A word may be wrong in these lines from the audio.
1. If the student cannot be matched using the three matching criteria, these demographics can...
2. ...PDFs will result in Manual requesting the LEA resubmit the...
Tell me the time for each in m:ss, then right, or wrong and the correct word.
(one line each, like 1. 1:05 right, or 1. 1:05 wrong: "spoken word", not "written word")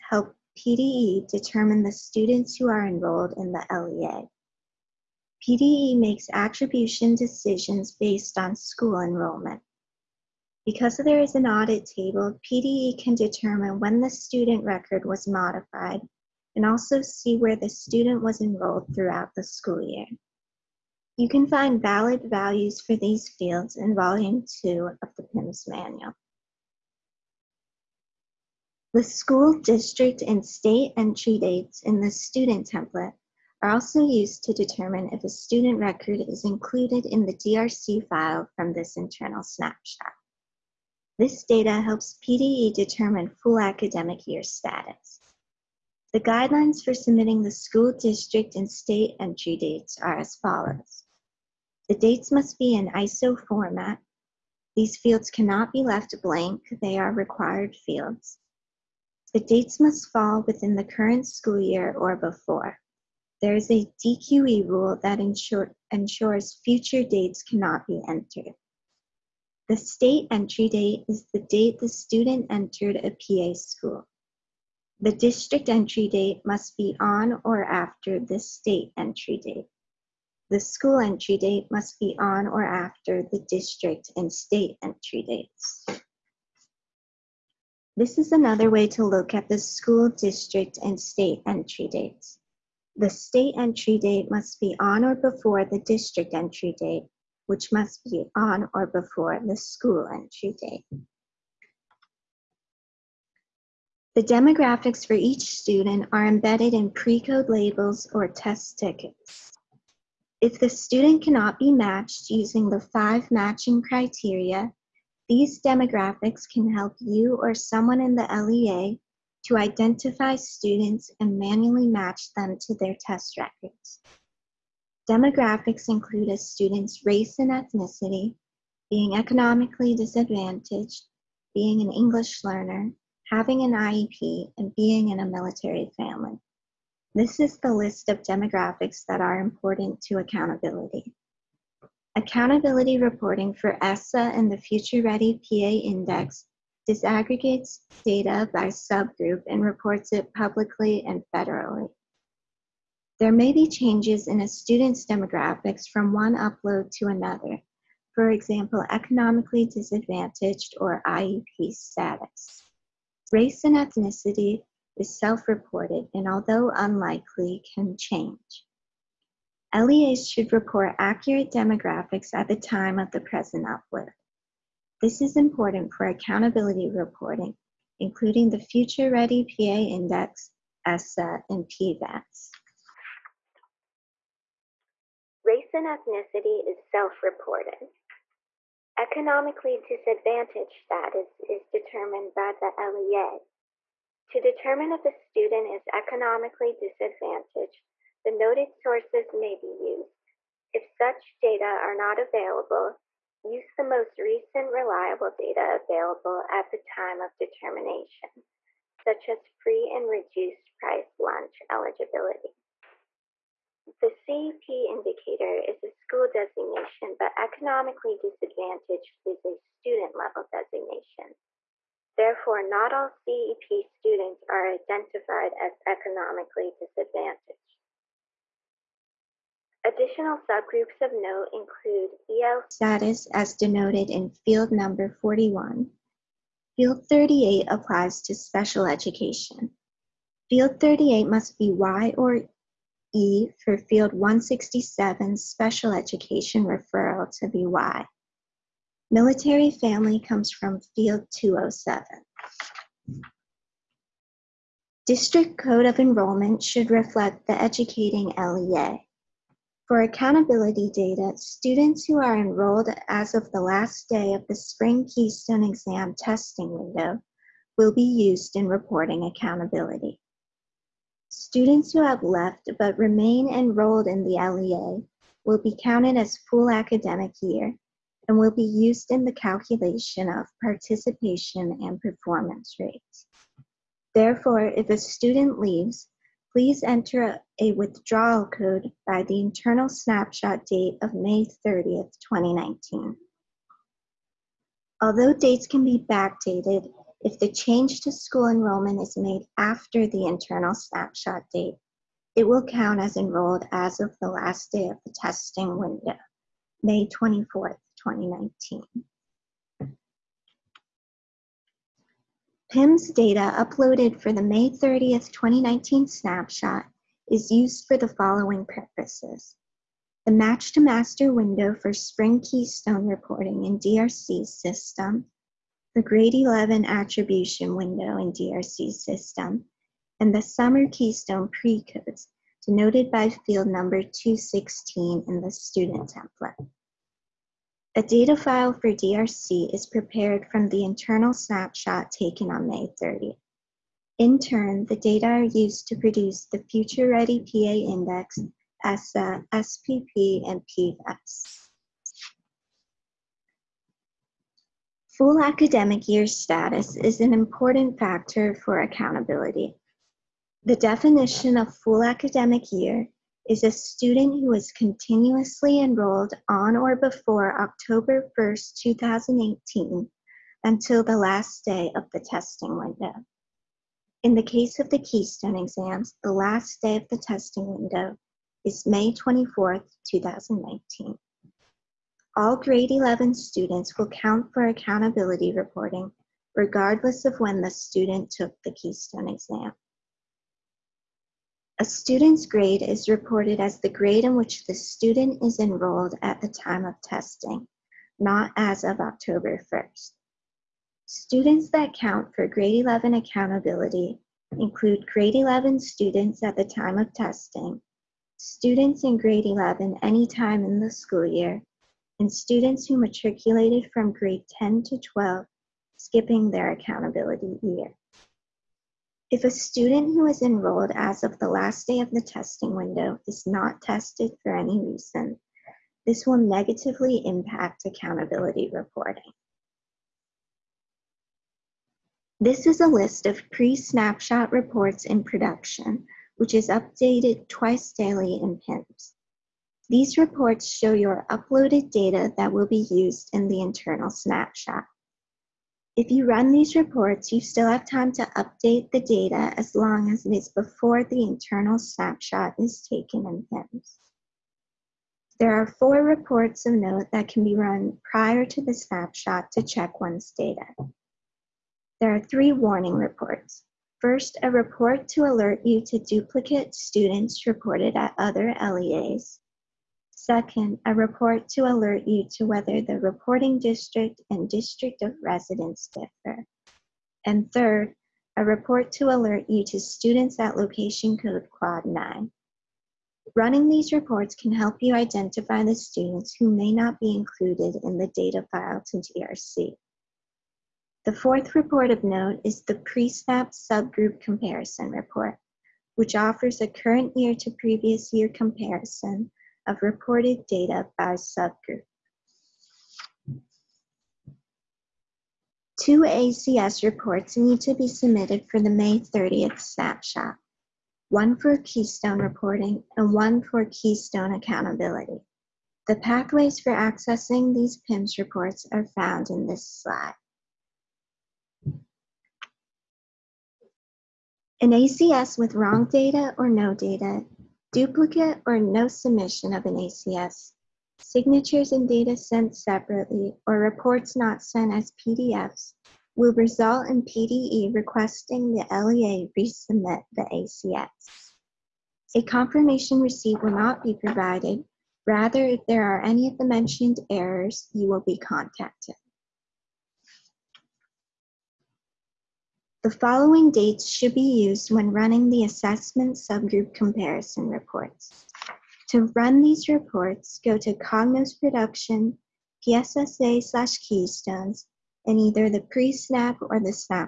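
1. 1:50 wrong: "five", not "three"
2. 8:54 wrong: "PDE", not "Manual".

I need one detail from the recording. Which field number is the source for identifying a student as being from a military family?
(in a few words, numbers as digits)
207.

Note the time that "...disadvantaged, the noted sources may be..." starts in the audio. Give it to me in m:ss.
3:16.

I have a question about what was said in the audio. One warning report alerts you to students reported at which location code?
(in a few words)
quad 9.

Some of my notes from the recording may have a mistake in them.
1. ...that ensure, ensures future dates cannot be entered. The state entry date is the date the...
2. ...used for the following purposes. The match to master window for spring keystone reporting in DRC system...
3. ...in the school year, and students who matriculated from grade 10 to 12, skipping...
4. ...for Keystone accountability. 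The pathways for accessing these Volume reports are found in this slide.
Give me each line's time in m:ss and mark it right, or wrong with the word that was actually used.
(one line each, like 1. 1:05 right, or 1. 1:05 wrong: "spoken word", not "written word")
1. 1:05 right
2. 5:17 right
3. 6:50 right
4. 8:33 wrong: "PIMS", not "Volume".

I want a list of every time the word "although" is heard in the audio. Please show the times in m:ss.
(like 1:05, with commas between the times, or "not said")
2:46, 4:55.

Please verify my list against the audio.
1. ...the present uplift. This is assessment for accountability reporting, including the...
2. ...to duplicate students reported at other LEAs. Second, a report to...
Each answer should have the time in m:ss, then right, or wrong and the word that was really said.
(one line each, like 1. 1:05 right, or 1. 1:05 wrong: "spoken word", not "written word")
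1. 2:53 wrong: "important", not "assessment"
2. 7:45 right.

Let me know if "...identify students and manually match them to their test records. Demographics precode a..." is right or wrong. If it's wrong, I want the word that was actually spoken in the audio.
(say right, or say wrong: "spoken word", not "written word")
wrong: "include", not "precode".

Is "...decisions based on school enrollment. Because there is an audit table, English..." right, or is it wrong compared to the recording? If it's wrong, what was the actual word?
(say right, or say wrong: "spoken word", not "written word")
wrong: "PDE", not "English".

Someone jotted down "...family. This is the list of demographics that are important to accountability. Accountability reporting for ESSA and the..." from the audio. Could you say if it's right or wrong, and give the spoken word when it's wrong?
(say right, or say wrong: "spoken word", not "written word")
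right.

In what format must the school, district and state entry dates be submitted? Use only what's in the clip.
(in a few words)
ISO format.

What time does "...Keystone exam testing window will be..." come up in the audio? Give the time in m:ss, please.
4:25.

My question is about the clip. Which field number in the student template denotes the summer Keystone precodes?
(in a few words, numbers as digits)
216.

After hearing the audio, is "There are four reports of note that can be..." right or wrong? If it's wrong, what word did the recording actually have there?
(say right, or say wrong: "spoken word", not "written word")
right.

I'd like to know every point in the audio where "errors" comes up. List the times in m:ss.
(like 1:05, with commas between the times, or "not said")
9:07.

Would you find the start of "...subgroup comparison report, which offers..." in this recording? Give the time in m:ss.
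8:13.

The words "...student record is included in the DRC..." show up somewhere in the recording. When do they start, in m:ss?
0:35.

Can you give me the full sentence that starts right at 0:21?
You can find valid values for these fields in Volume 2 of the PIMS Manual.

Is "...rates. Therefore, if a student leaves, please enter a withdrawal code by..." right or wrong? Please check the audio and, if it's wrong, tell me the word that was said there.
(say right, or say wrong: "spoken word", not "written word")
right.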